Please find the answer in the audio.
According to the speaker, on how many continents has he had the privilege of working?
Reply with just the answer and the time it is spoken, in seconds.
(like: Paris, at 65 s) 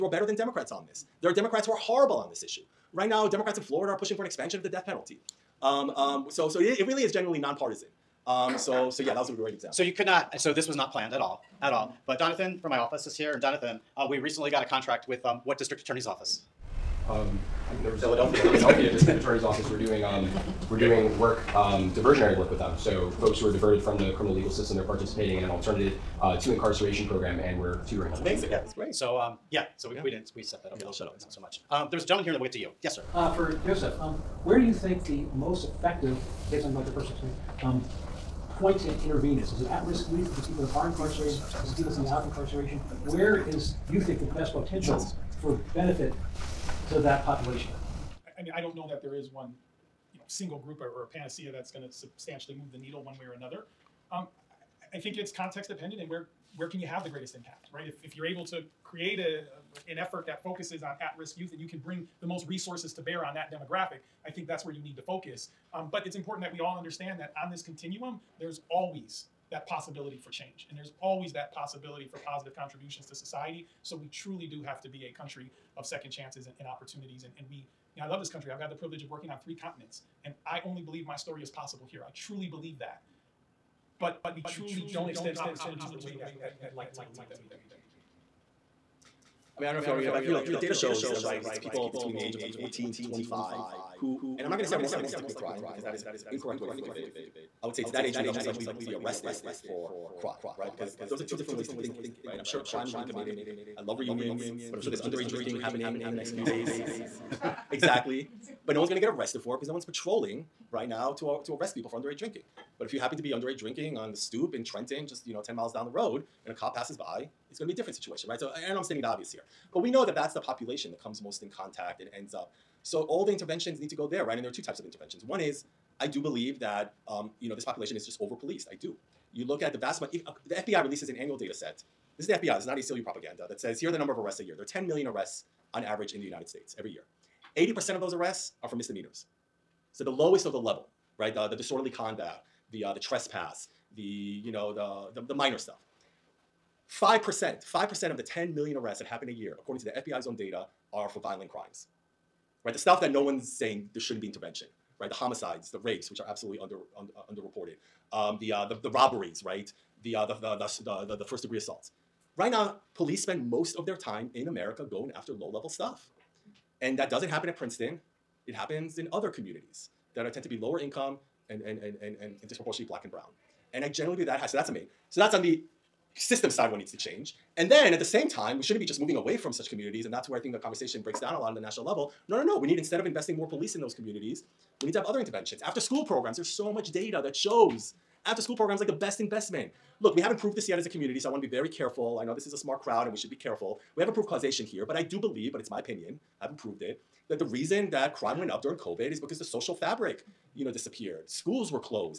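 3, at 79 s.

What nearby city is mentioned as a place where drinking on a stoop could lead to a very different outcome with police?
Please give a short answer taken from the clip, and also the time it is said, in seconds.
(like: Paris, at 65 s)
Trenton, at 114 s.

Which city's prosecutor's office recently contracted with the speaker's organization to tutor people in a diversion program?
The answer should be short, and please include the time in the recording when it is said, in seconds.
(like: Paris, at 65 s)
Philadelphia, at 18 s.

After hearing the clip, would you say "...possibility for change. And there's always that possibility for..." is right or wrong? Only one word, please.
right.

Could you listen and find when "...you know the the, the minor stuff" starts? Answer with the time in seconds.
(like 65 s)
144 s.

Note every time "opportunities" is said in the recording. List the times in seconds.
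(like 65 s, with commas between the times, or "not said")
76 s, 85 s.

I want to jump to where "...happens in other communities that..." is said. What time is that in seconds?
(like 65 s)
168 s.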